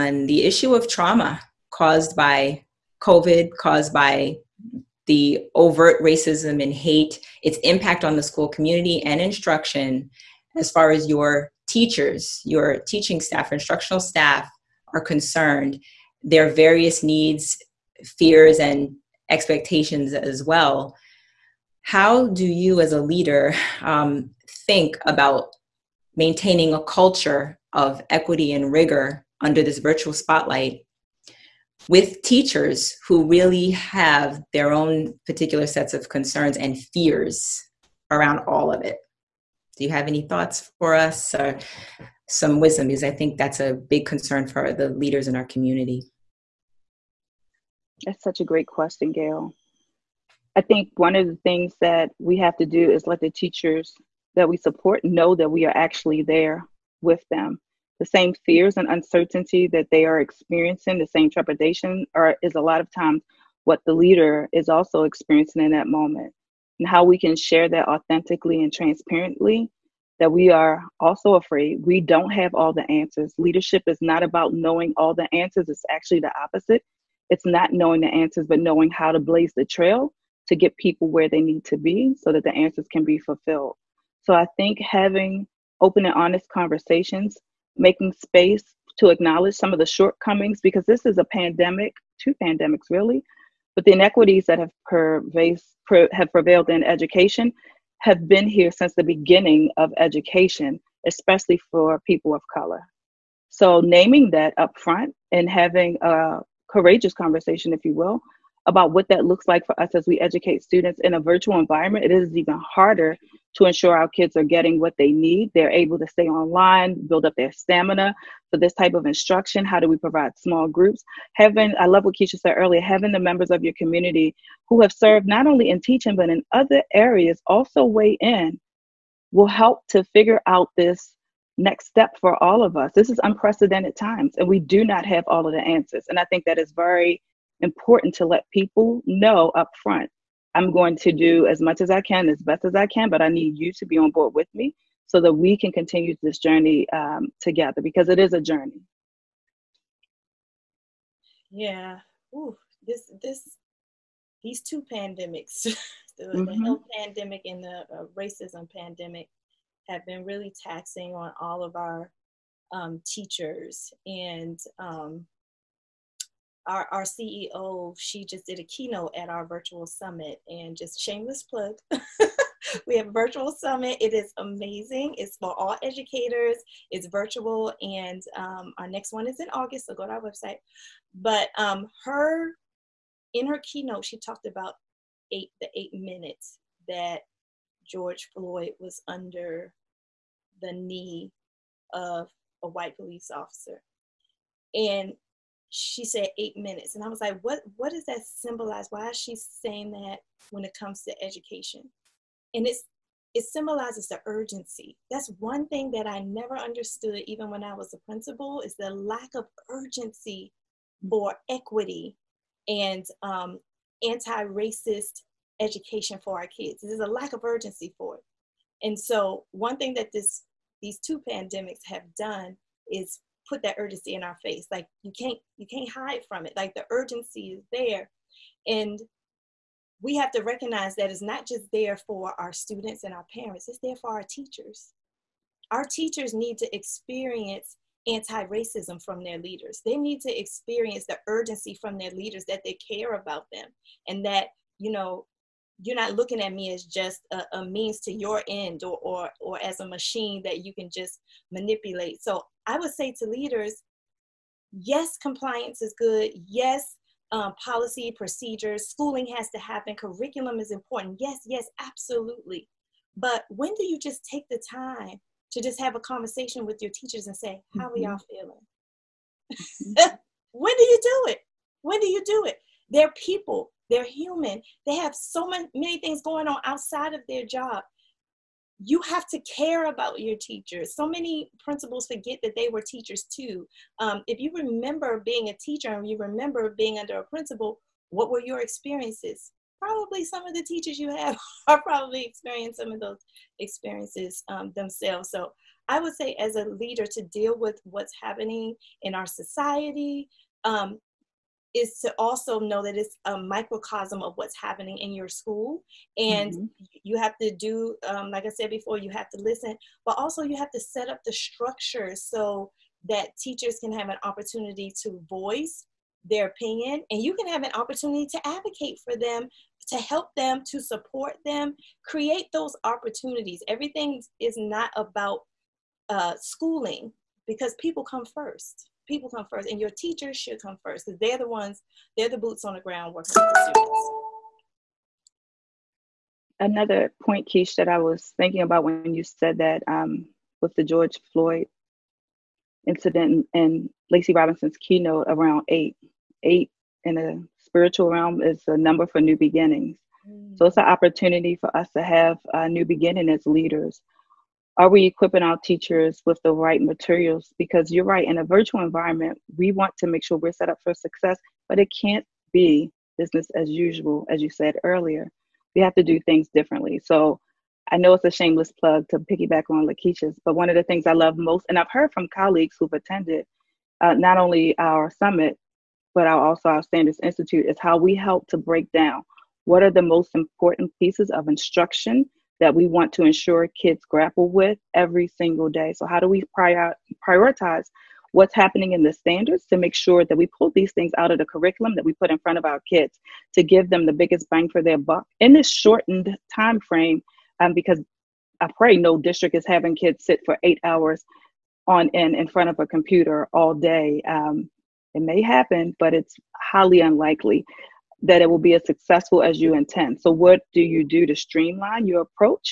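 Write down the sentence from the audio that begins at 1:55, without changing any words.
They're able to stay online, build up their stamina for this type of instruction.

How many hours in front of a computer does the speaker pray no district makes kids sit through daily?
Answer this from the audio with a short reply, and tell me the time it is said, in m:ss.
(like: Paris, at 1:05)
8, at 6:40.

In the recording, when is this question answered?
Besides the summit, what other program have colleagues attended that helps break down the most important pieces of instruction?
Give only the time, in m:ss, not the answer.
6:16.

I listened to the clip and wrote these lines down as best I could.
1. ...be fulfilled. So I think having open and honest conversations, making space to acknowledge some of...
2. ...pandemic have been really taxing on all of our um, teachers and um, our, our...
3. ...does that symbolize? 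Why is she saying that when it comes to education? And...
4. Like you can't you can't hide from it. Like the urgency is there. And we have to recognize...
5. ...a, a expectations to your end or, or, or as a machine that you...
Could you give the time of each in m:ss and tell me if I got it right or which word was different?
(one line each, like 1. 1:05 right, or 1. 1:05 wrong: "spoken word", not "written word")
1. 1:23 right
2. 2:38 right
3. 3:17 right
4. 3:44 right
5. 4:07 wrong: "means", not "expectations".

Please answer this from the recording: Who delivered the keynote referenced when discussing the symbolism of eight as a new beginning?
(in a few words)
Lacey Robinson.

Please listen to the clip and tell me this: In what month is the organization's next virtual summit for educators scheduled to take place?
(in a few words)
August.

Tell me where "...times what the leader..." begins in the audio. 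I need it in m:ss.
1:02.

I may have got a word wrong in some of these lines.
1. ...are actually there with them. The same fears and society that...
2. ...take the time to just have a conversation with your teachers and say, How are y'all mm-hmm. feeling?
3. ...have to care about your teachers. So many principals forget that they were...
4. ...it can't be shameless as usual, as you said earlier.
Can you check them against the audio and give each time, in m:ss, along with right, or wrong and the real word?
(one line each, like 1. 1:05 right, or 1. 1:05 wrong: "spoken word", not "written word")
1. 0:55 wrong: "uncertainty", not "society"
2. 4:24 right
3. 4:39 right
4. 6:01 wrong: "business", not "shameless".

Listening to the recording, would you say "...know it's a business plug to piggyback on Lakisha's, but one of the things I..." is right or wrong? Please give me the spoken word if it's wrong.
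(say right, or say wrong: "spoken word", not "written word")
wrong: "shameless", not "business".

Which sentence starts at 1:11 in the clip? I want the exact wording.
We don't have all the answers.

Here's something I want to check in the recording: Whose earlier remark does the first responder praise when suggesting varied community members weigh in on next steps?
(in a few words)
Keisha.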